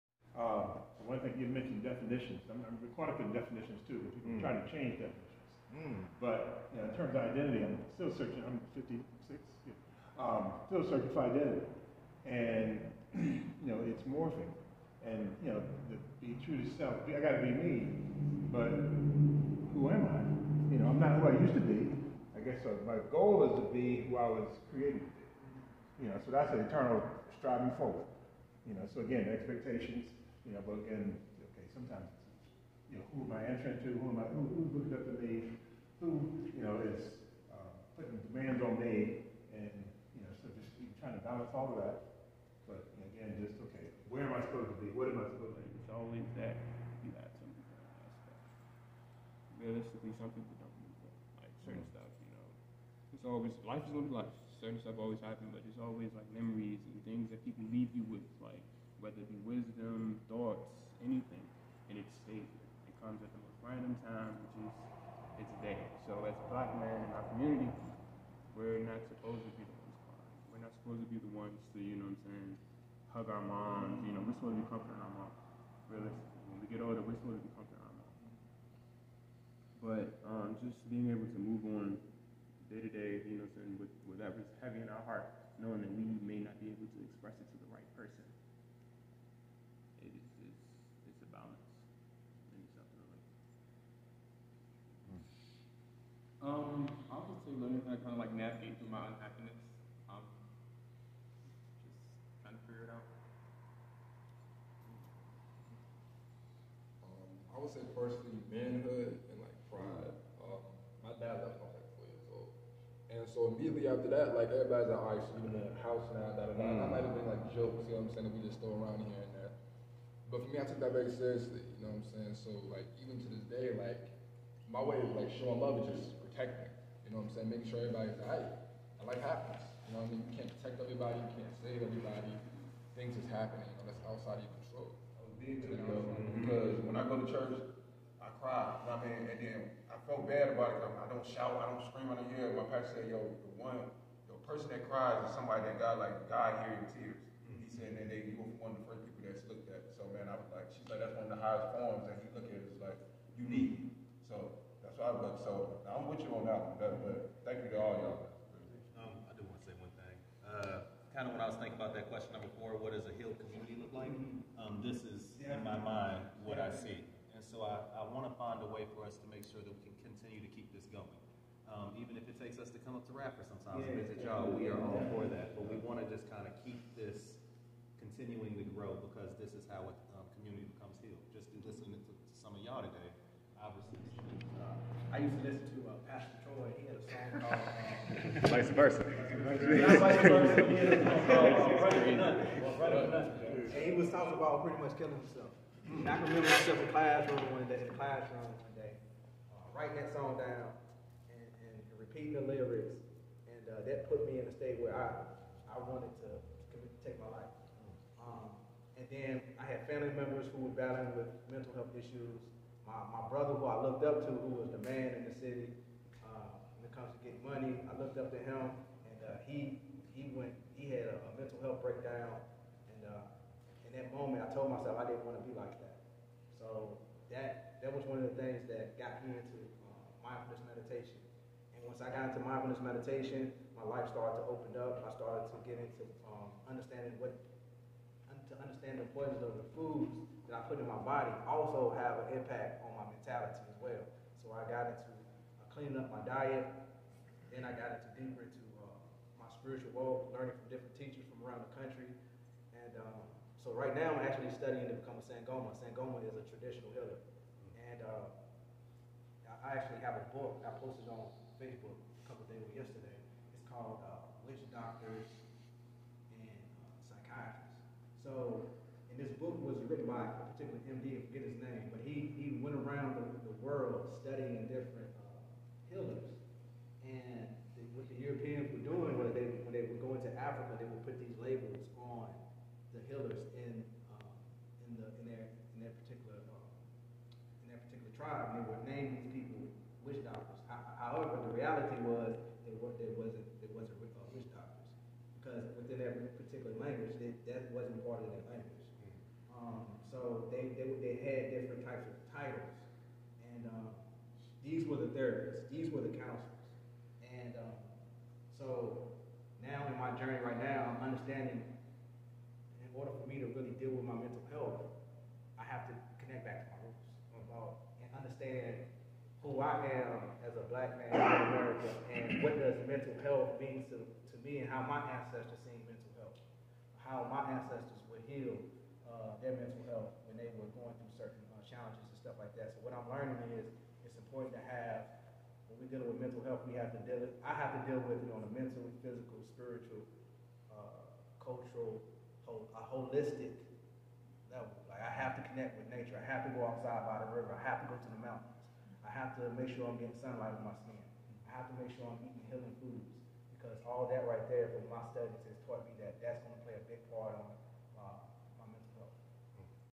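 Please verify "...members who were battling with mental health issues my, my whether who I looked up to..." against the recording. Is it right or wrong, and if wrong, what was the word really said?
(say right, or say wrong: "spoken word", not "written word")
wrong: "brother", not "whether".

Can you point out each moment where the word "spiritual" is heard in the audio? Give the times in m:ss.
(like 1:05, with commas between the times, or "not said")
4:09, 5:39.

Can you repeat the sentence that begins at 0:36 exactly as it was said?
Who, you know, is uh, putting demands on me?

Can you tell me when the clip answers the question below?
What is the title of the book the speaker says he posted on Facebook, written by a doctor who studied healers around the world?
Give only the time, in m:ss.
4:24.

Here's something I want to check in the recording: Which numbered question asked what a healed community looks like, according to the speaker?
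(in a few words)
4.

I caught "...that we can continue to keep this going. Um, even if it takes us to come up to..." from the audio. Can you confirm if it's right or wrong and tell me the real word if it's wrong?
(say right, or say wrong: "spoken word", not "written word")
right.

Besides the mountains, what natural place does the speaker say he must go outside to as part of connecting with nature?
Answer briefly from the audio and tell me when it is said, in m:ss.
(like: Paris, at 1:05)
the river, at 5:47.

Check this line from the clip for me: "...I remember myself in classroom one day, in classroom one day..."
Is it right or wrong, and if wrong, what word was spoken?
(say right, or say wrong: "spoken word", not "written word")
right.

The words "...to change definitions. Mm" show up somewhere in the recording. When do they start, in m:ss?
0:04.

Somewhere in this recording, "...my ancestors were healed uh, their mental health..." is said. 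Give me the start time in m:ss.
5:27.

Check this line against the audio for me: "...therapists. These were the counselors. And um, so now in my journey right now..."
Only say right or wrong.
right.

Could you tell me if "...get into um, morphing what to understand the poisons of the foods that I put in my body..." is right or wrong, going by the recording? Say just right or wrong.
wrong.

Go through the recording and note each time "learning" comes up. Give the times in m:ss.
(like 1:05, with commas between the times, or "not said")
1:37, 4:10, 5:33.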